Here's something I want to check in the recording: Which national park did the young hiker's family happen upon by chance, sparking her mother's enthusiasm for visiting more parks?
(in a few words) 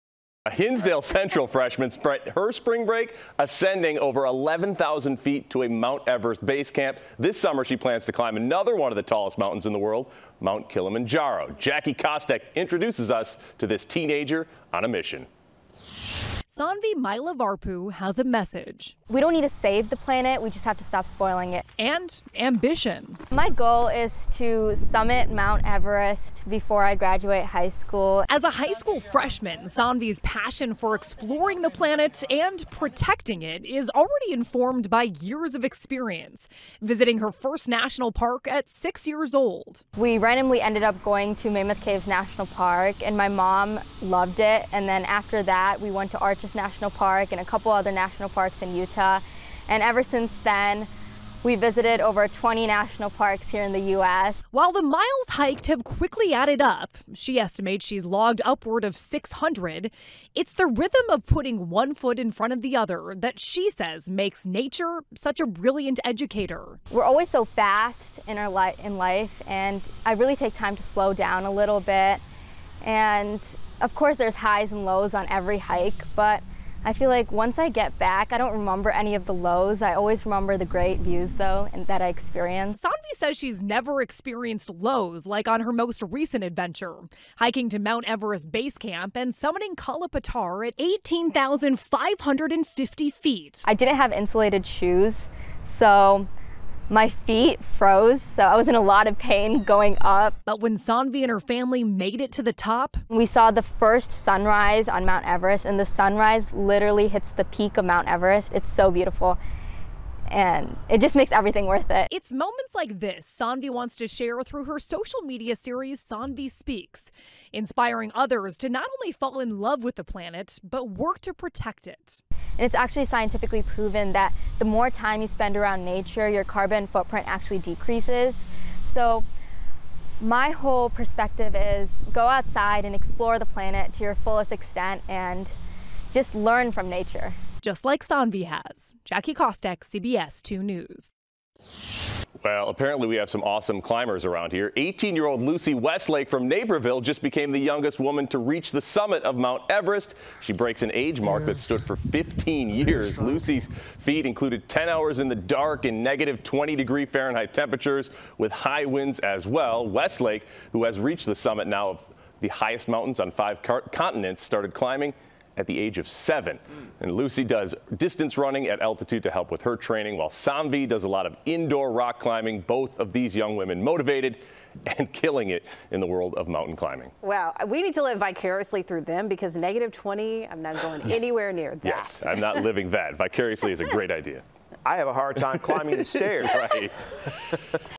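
Mammoth Caves National Park.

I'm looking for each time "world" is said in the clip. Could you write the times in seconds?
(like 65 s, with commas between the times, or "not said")
9 s, 176 s.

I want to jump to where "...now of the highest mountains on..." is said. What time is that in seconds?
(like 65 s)
161 s.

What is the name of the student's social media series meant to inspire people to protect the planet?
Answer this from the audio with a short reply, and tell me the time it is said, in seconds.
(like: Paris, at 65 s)
Saanvi Speaks, at 116 s.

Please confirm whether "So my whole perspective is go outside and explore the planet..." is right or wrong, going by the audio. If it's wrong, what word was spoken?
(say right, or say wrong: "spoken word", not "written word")
right.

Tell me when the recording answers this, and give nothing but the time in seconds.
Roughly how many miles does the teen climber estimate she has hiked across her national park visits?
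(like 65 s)
58 s.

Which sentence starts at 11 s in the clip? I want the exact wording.
Jackie Kostek introduces us to this teenager on a mission.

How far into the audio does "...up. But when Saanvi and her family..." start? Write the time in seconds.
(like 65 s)
100 s.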